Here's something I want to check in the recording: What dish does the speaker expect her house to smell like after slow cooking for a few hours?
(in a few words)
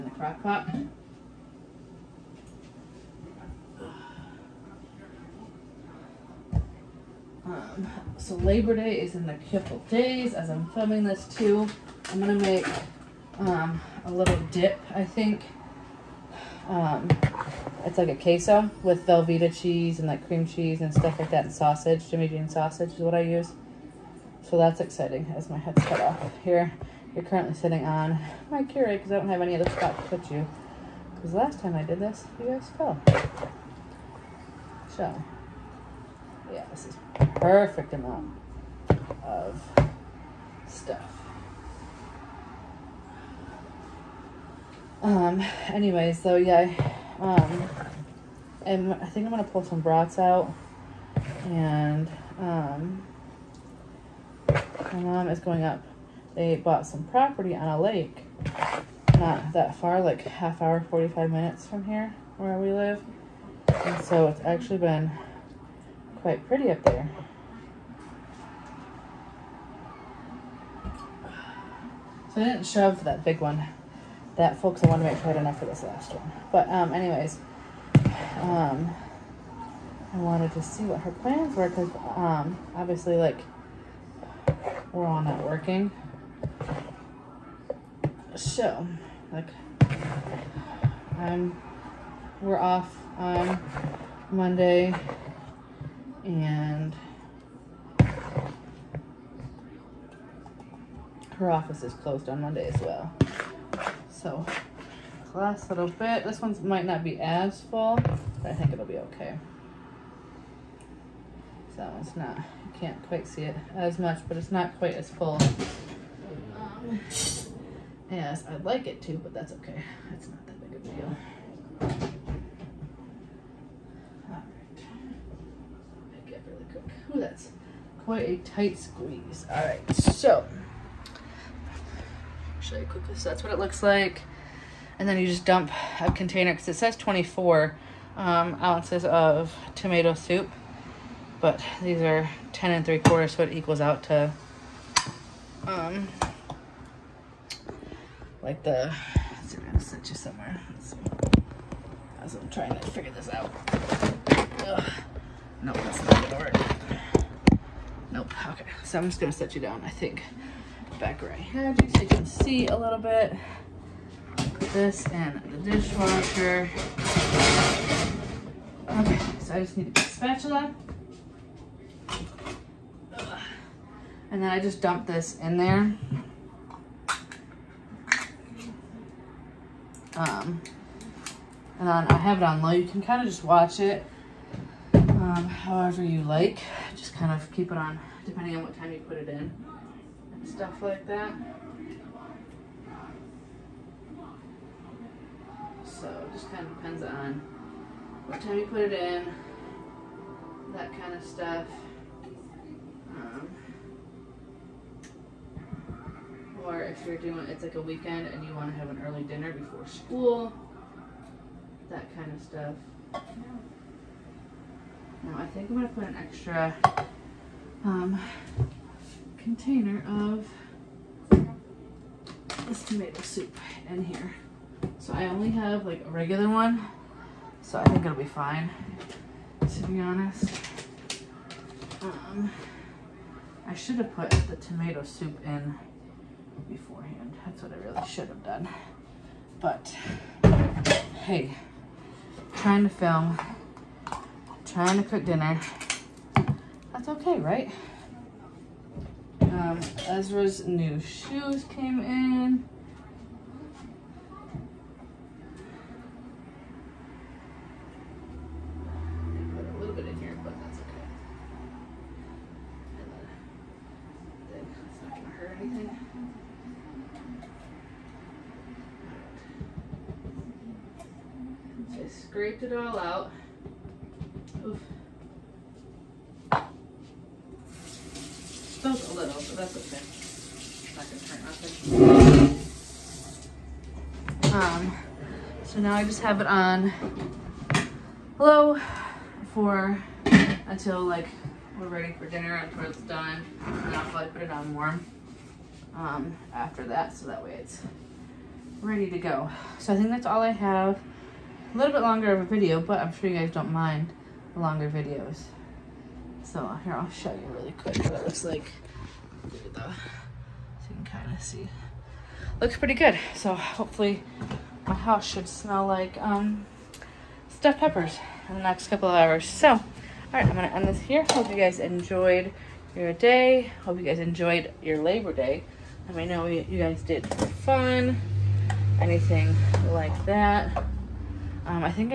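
stuffed peppers.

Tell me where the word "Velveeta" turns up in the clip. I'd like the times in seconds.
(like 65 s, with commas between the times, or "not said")
19 s.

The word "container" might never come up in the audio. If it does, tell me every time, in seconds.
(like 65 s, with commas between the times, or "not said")
136 s, 219 s.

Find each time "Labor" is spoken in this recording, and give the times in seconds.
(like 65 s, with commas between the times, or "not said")
8 s, 324 s.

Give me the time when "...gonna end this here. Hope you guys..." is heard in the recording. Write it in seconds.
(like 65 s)
320 s.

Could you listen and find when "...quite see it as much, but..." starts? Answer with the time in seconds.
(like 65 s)
113 s.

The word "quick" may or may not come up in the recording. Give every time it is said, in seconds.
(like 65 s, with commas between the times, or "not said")
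307 s.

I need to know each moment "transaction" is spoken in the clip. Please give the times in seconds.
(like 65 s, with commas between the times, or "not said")
not said.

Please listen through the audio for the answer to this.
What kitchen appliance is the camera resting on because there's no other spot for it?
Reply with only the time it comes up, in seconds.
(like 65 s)
28 s.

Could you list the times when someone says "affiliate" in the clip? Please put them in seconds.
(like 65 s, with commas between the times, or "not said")
not said.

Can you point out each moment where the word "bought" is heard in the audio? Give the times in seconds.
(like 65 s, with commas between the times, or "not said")
56 s.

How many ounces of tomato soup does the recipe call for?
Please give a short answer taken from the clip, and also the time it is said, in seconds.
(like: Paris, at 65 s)
24, at 136 s.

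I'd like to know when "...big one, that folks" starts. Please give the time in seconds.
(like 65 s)
73 s.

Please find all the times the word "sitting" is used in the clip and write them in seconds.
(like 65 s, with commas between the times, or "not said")
27 s.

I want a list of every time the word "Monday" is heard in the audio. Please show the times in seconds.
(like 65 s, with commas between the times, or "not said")
94 s, 102 s.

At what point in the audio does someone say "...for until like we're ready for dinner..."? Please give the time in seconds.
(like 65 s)
289 s.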